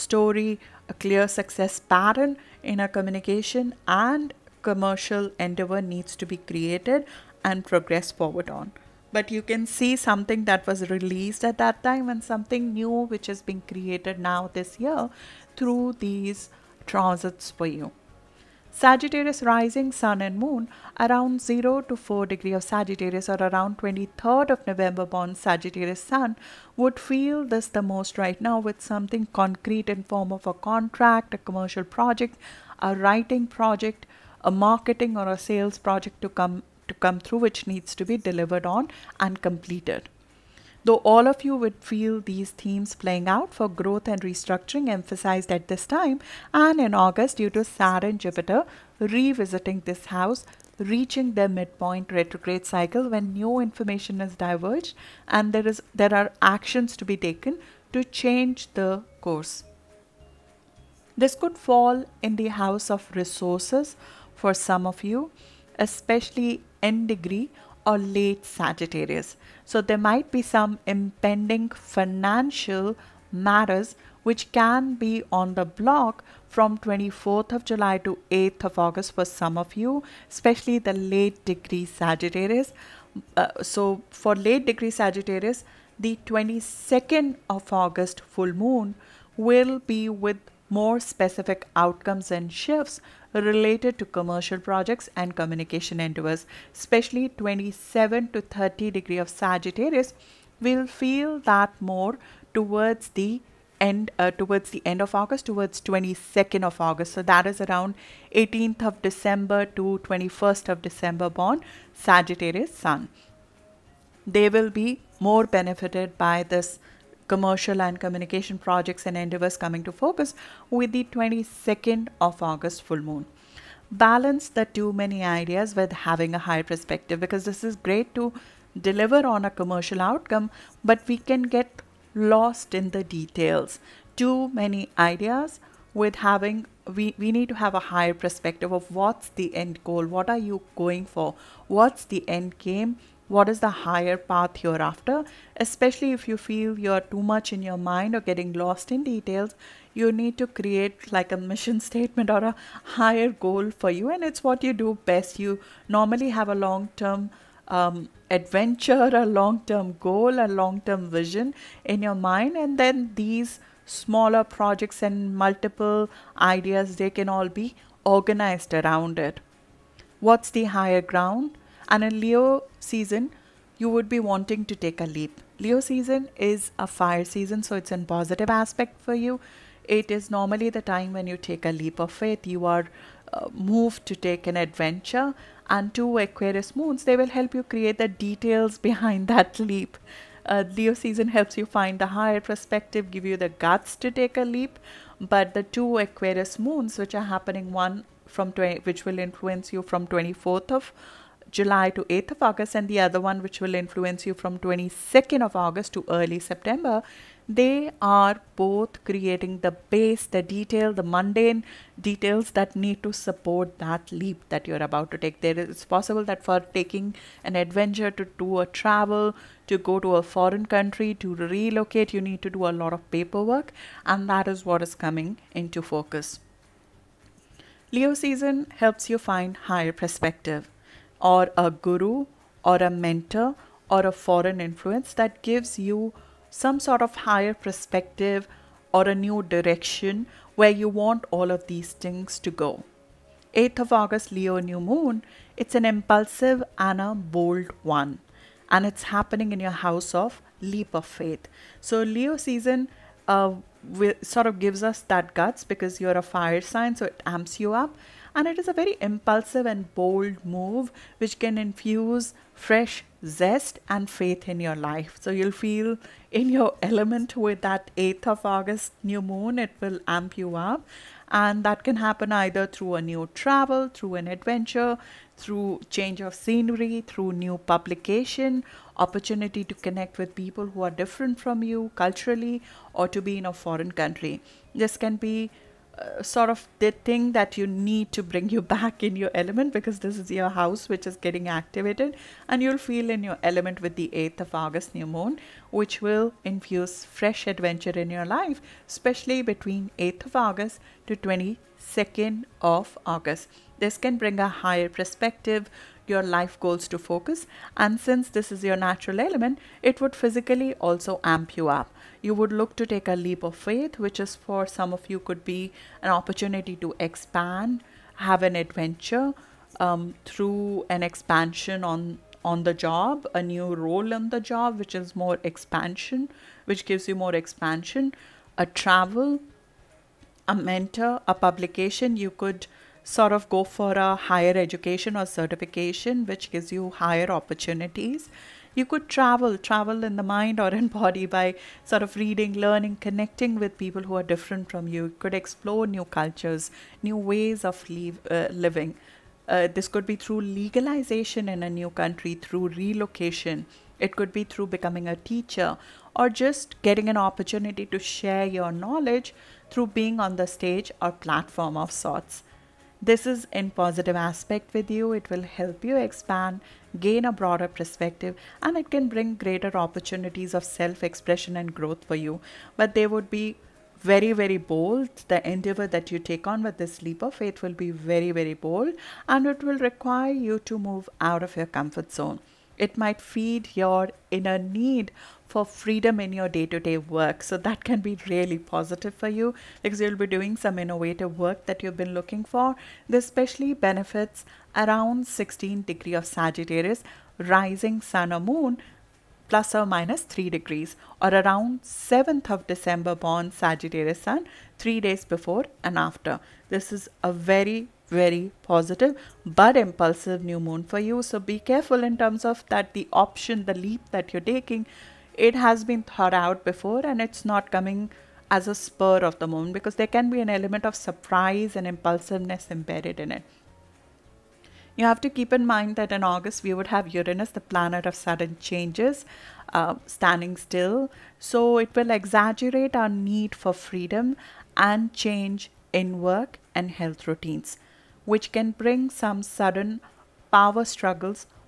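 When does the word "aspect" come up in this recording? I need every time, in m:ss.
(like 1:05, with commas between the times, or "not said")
2:58, 6:04.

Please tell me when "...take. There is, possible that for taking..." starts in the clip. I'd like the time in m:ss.
3:35.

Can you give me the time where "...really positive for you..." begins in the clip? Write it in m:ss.
6:28.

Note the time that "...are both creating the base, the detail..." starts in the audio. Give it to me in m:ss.
3:28.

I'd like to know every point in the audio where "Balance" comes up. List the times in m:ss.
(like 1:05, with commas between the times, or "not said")
2:03.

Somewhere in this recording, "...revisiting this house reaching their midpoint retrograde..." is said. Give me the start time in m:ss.
0:48.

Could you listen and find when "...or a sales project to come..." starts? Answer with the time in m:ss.
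0:35.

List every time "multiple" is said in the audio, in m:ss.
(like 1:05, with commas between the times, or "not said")
2:45.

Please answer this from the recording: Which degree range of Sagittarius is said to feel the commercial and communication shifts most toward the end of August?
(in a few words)
27 to 30 degrees.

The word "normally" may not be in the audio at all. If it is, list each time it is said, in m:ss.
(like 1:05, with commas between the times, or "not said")
2:35, 3:00.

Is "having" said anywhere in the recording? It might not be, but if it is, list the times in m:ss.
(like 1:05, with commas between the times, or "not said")
2:05, 2:16.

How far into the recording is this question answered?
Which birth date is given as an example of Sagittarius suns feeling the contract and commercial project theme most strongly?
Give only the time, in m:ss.
0:23.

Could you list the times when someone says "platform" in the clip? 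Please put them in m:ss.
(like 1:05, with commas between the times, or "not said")
6:01.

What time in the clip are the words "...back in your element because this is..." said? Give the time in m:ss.
4:48.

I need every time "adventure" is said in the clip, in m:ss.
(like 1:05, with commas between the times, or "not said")
2:38, 3:04, 3:37, 4:34, 4:57, 5:18.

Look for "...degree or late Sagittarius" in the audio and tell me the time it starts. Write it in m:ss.
1:07.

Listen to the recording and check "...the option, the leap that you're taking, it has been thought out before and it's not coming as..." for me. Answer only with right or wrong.
right.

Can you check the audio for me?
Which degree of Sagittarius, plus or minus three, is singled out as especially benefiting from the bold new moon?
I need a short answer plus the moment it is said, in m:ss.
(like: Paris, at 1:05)
16 degrees, at 6:35.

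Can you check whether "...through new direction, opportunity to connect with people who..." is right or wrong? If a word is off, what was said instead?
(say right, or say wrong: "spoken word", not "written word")
wrong: "publication", not "direction".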